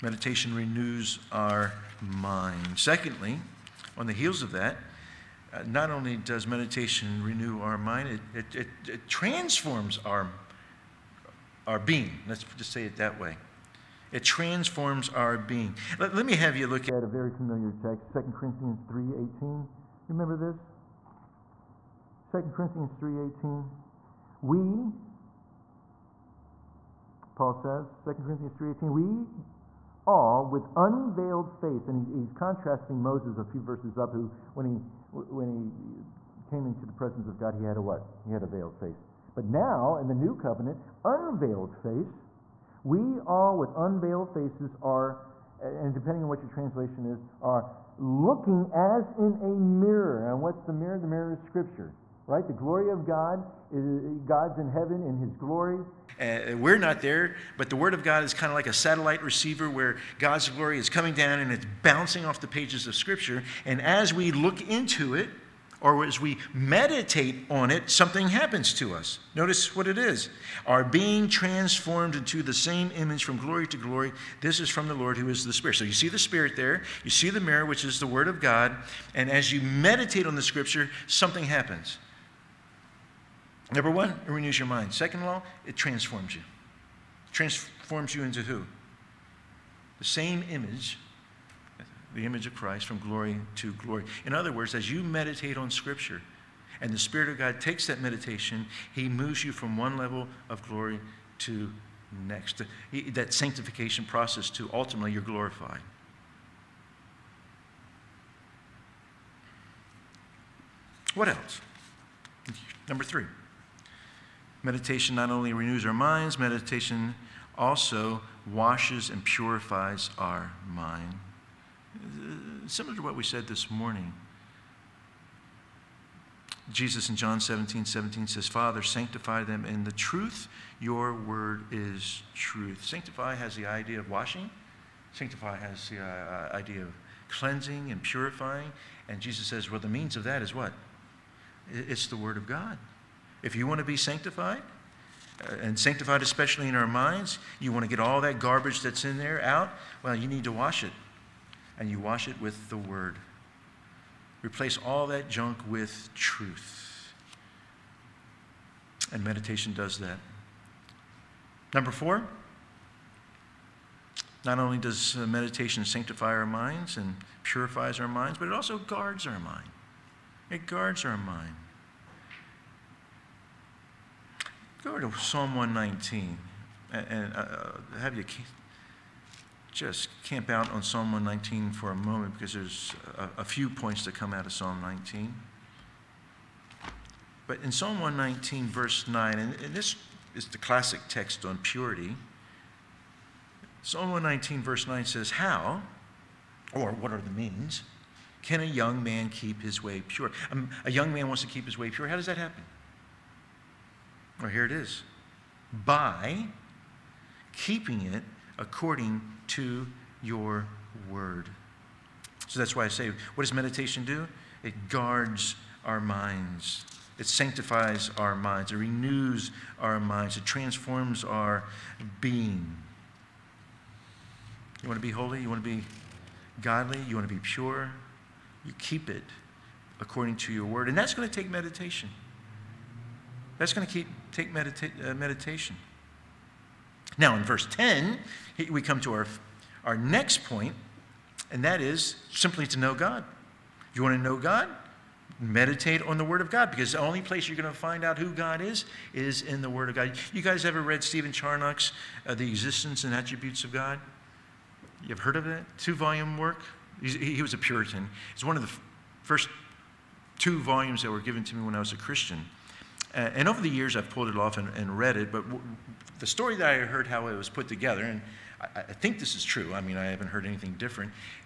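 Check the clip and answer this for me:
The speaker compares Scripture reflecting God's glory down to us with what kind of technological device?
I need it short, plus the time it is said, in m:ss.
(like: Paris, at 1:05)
Satellite receiver, at 0:58.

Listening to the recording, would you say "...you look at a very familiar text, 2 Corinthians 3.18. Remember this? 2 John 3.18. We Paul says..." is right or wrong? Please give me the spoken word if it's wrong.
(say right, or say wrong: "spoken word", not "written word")
wrong: "Corinthians", not "John".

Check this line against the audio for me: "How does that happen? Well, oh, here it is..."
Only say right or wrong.
right.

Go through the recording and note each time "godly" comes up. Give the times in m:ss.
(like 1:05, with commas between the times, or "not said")
3:46.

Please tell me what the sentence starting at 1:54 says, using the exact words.
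Meditation not only renews our minds, meditation also washes and purifies our mind.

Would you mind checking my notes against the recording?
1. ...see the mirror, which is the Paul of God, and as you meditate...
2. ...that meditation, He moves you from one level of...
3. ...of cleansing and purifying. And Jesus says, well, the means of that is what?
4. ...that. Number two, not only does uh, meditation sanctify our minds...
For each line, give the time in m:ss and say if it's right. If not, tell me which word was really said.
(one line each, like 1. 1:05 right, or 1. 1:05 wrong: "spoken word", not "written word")
1. 1:17 wrong: "Word", not "Paul"
2. 1:37 right
3. 2:16 right
4. 2:39 wrong: "four", not "two".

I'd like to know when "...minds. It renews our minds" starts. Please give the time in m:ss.
3:38.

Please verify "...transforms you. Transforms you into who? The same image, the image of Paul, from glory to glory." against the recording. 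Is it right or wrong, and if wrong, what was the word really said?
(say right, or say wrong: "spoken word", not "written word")
wrong: "Christ", not "Paul".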